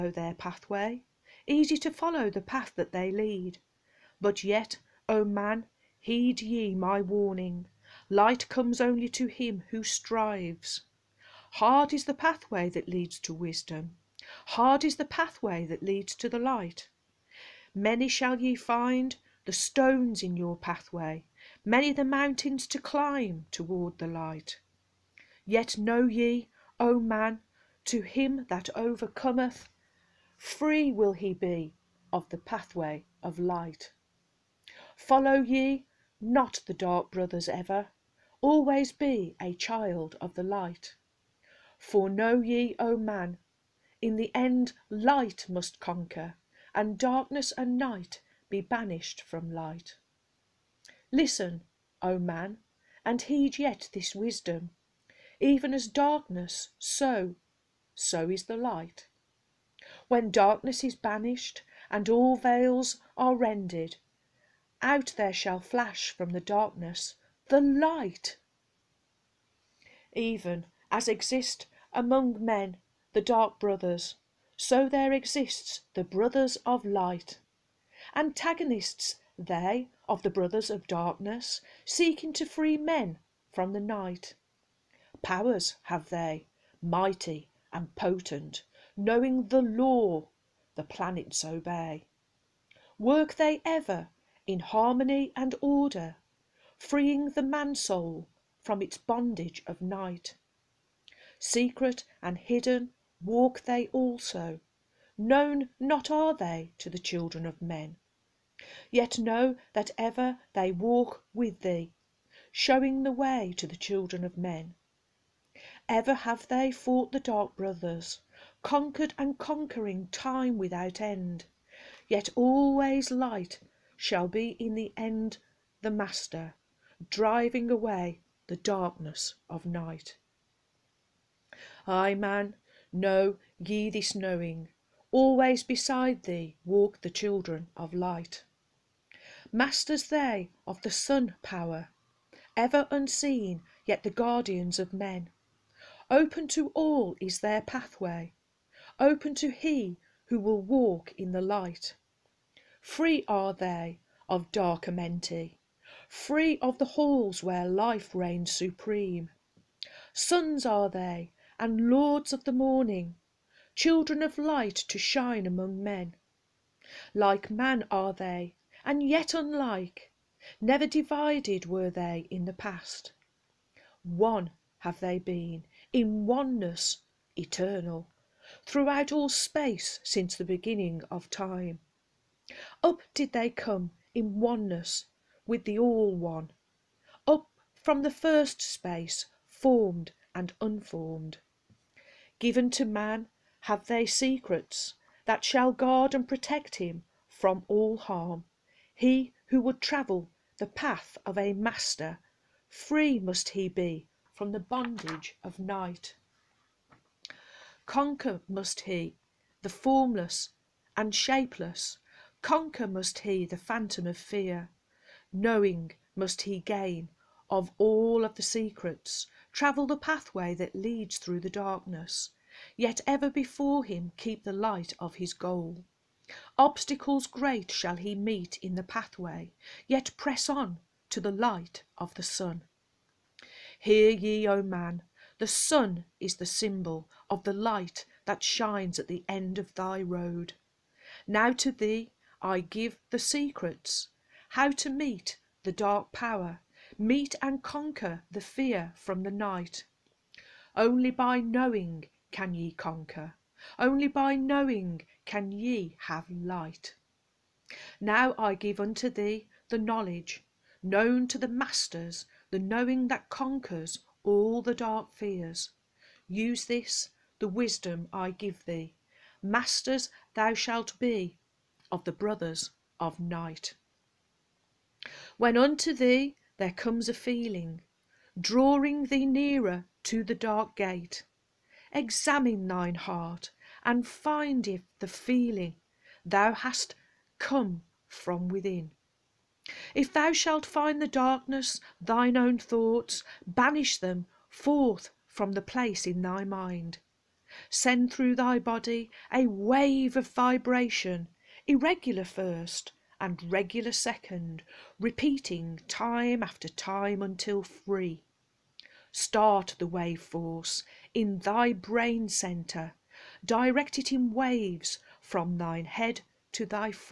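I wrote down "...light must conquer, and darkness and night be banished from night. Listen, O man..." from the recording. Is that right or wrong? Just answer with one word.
wrong.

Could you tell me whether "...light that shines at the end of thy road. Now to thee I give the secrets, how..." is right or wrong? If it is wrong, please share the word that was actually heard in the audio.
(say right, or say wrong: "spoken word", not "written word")
right.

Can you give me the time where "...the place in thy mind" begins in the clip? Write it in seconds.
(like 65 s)
295 s.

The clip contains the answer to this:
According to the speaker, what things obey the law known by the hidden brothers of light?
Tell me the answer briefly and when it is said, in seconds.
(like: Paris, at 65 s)
planets, at 90 s.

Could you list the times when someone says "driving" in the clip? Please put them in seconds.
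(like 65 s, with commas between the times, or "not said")
127 s.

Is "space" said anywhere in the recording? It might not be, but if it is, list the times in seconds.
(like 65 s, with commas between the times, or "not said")
179 s, 188 s.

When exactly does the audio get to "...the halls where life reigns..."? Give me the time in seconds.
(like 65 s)
156 s.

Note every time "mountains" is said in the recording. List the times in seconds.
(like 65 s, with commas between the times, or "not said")
22 s.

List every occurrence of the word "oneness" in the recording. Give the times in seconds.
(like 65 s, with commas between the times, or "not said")
176 s, 184 s.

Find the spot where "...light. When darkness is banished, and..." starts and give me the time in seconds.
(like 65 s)
58 s.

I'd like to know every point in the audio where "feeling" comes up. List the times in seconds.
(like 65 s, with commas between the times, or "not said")
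277 s, 285 s.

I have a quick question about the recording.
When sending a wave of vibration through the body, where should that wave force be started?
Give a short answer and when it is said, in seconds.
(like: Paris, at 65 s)
brain centre, at 311 s.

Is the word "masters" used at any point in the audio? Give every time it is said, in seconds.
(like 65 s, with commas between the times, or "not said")
125 s, 139 s, 201 s, 261 s, 269 s.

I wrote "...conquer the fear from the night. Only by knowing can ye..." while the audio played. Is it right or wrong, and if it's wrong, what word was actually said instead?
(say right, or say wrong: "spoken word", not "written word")
right.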